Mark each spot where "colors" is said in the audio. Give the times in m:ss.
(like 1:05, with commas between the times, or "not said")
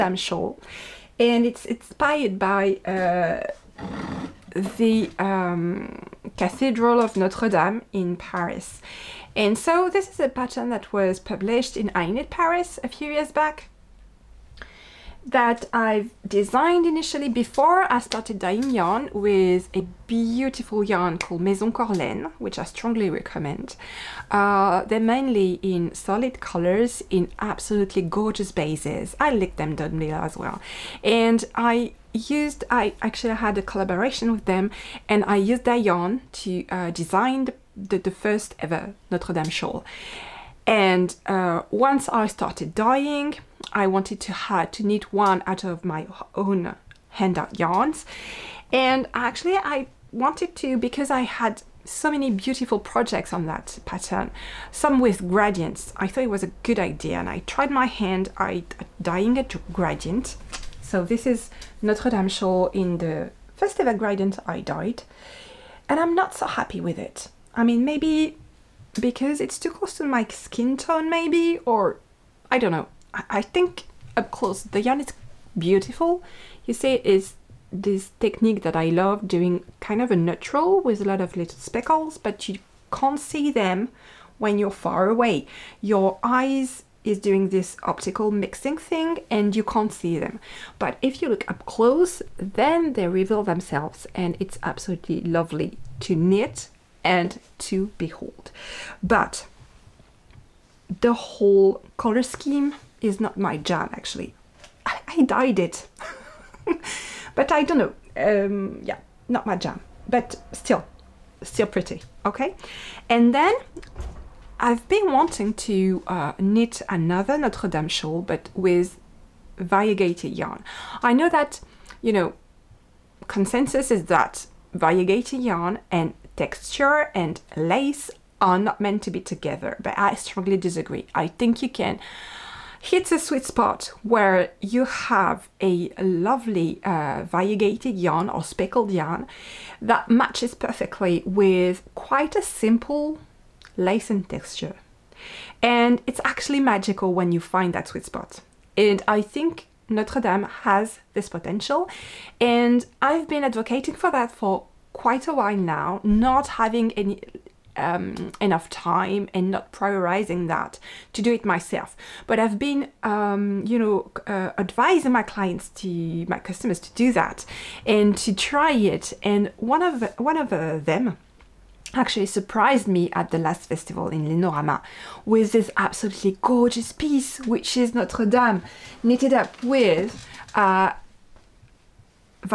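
0:26, 1:41.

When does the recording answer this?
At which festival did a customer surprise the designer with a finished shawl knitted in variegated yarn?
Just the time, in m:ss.
2:54.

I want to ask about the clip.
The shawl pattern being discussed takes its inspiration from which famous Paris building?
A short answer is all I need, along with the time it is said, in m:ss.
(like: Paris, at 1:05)
Cathedral of Notre Dame, at 0:06.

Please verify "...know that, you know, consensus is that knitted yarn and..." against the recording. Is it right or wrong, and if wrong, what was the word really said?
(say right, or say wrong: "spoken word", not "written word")
wrong: "variegated", not "knitted".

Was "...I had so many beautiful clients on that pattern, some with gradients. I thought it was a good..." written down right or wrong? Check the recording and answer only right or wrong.
wrong.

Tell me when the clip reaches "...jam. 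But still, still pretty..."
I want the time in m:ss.
1:49.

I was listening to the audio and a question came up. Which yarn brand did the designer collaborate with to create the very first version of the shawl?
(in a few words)
Maison Corlène.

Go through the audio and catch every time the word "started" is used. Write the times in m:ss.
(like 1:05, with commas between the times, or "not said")
0:17, 0:42.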